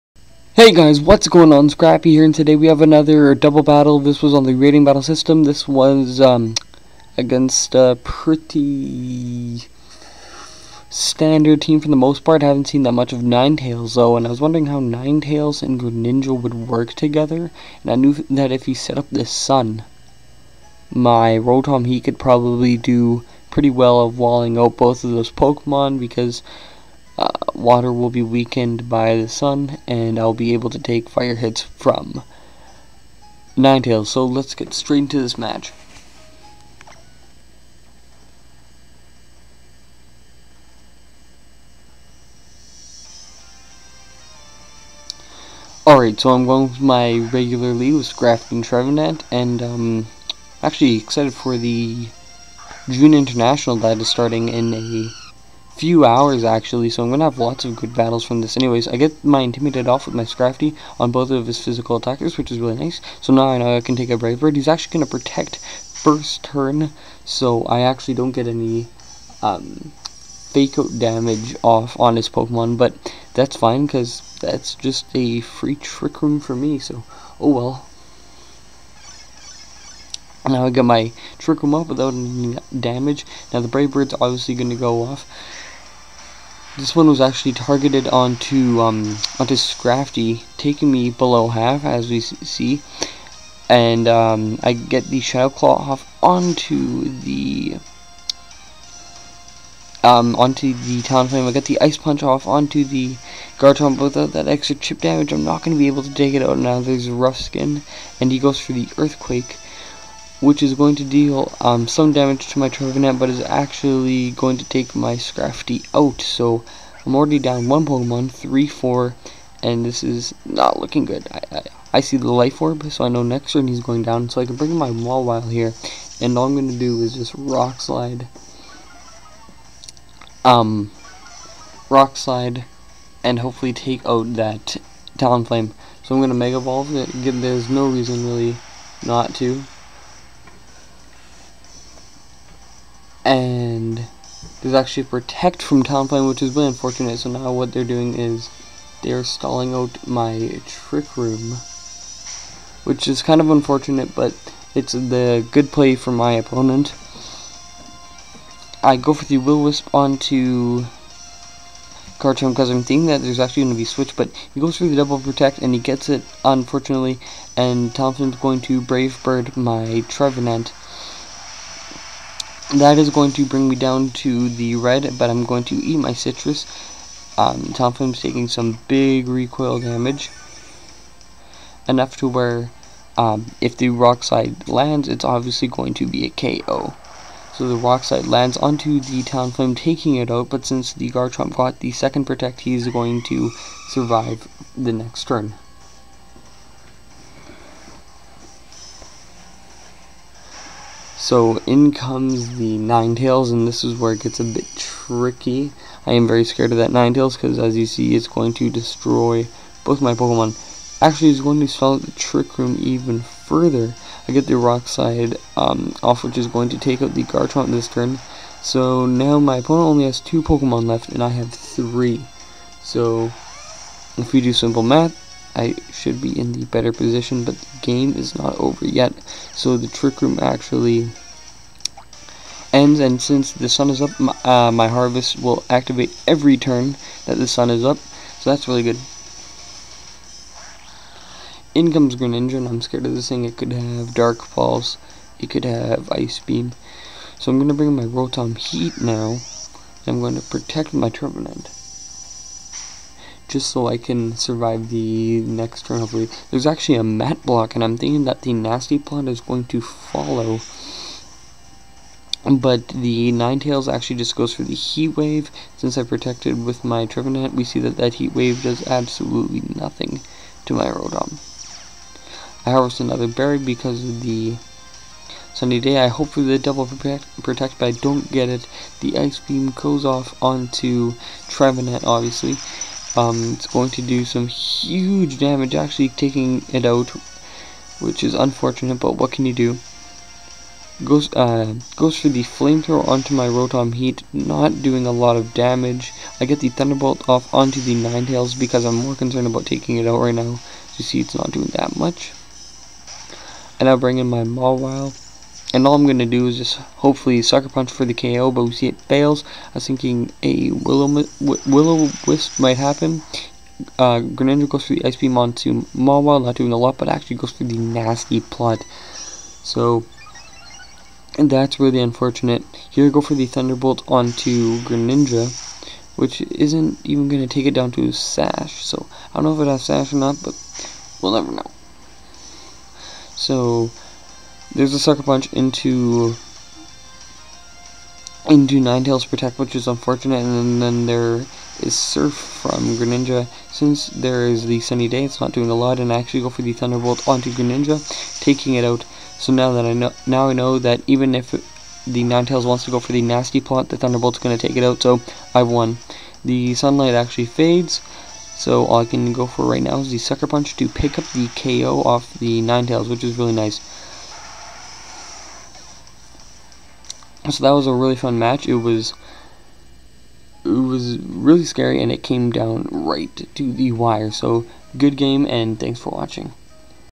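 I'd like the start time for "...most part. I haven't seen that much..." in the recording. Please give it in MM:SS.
00:11.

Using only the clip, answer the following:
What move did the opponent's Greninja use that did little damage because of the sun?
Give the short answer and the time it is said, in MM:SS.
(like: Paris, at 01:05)
Surf, at 05:41.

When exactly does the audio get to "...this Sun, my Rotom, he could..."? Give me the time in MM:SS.
00:19.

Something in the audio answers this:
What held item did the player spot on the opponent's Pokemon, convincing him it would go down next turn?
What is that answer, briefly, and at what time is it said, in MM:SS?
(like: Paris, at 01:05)
Life Orb, at 02:02.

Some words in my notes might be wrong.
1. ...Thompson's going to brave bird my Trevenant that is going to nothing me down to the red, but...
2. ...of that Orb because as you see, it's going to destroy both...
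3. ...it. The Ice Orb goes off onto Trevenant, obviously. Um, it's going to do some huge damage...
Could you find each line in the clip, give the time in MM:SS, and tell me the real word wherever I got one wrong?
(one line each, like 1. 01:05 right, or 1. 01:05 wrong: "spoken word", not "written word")
1. 02:47 wrong: "bring", not "nothing"
2. 03:26 wrong: "Ninetales", not "Orb"
3. 04:38 wrong: "Beam", not "Orb".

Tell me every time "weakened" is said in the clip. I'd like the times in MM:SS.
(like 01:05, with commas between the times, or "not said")
00:28.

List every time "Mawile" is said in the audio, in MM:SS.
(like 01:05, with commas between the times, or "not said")
02:04, 05:04, 05:15.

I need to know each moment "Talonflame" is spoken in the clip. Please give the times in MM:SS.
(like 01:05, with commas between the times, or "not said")
01:41, 02:15, 02:25, 02:57, 03:09.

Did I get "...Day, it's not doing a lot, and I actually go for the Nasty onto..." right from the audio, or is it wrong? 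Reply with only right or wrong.
wrong.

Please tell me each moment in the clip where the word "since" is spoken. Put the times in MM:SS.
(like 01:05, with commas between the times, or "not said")
03:10, 03:53, 04:25, 05:43.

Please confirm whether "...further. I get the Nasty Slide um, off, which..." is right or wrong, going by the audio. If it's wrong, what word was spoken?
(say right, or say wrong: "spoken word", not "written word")
wrong: "Rock", not "Nasty".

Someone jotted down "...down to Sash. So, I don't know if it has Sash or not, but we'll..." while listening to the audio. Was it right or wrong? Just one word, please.
right.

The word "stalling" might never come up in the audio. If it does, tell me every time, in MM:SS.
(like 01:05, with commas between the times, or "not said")
02:29.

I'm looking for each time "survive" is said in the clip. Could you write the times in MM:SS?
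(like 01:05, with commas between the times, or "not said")
03:13, 04:14.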